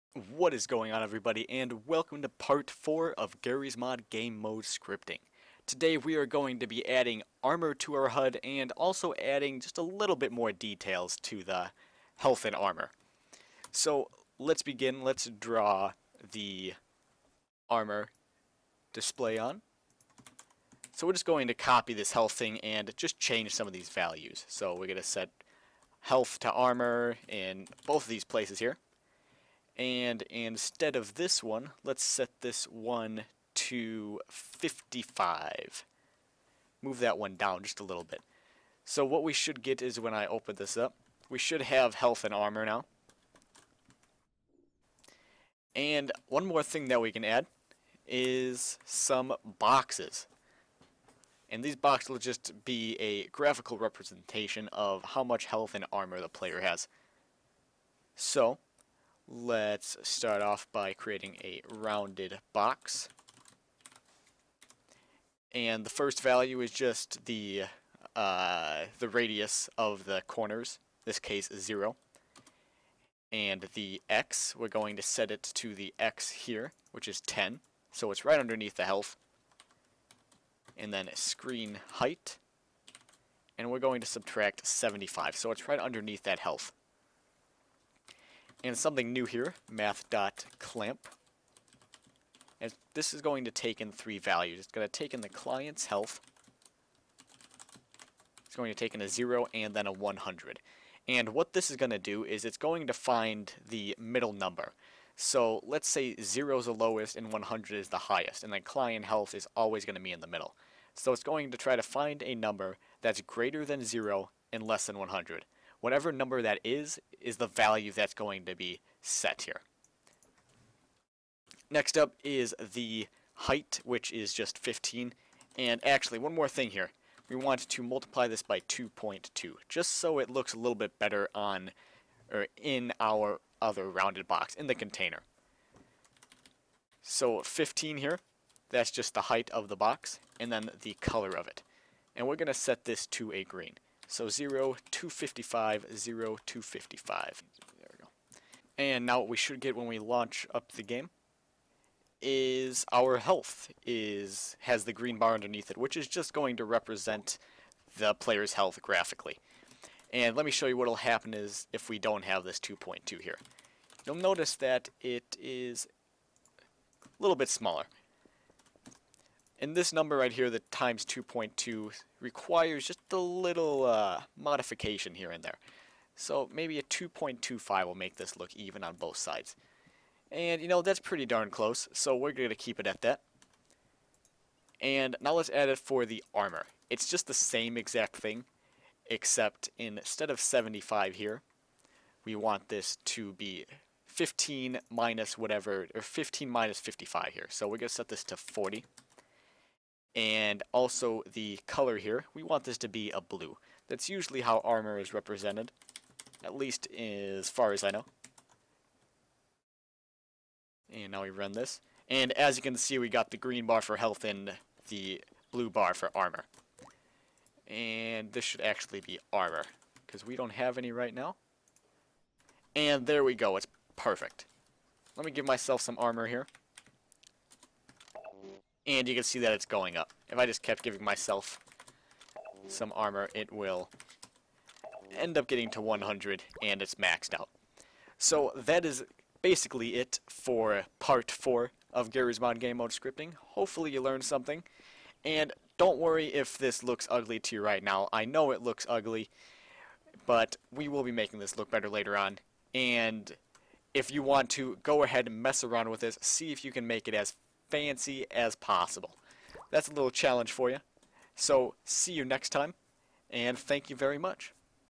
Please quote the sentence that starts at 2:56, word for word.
So maybe a 2.25 will make this look even on both sides.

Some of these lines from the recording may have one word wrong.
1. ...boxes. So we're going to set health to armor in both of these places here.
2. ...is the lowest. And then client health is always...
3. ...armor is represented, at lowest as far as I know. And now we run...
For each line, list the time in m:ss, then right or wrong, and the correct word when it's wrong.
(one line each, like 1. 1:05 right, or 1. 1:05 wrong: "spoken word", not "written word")
1. 0:23 wrong: "values", not "boxes"
2. 1:47 wrong: "highest", not "lowest"
3. 3:24 wrong: "least", not "lowest".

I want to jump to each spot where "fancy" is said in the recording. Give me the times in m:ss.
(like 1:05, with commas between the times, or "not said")
4:17.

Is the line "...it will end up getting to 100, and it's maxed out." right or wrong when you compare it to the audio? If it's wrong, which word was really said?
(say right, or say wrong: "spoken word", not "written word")
right.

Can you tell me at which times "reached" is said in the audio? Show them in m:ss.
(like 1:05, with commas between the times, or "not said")
not said.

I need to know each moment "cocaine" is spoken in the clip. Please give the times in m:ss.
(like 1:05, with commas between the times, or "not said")
not said.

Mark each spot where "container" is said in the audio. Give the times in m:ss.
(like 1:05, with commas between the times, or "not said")
2:14.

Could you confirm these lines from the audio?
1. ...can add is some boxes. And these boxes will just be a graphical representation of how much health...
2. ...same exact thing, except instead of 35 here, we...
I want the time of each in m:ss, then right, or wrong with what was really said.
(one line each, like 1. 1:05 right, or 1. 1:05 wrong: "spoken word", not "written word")
1. 0:47 right
2. 3:07 wrong: "75", not "35".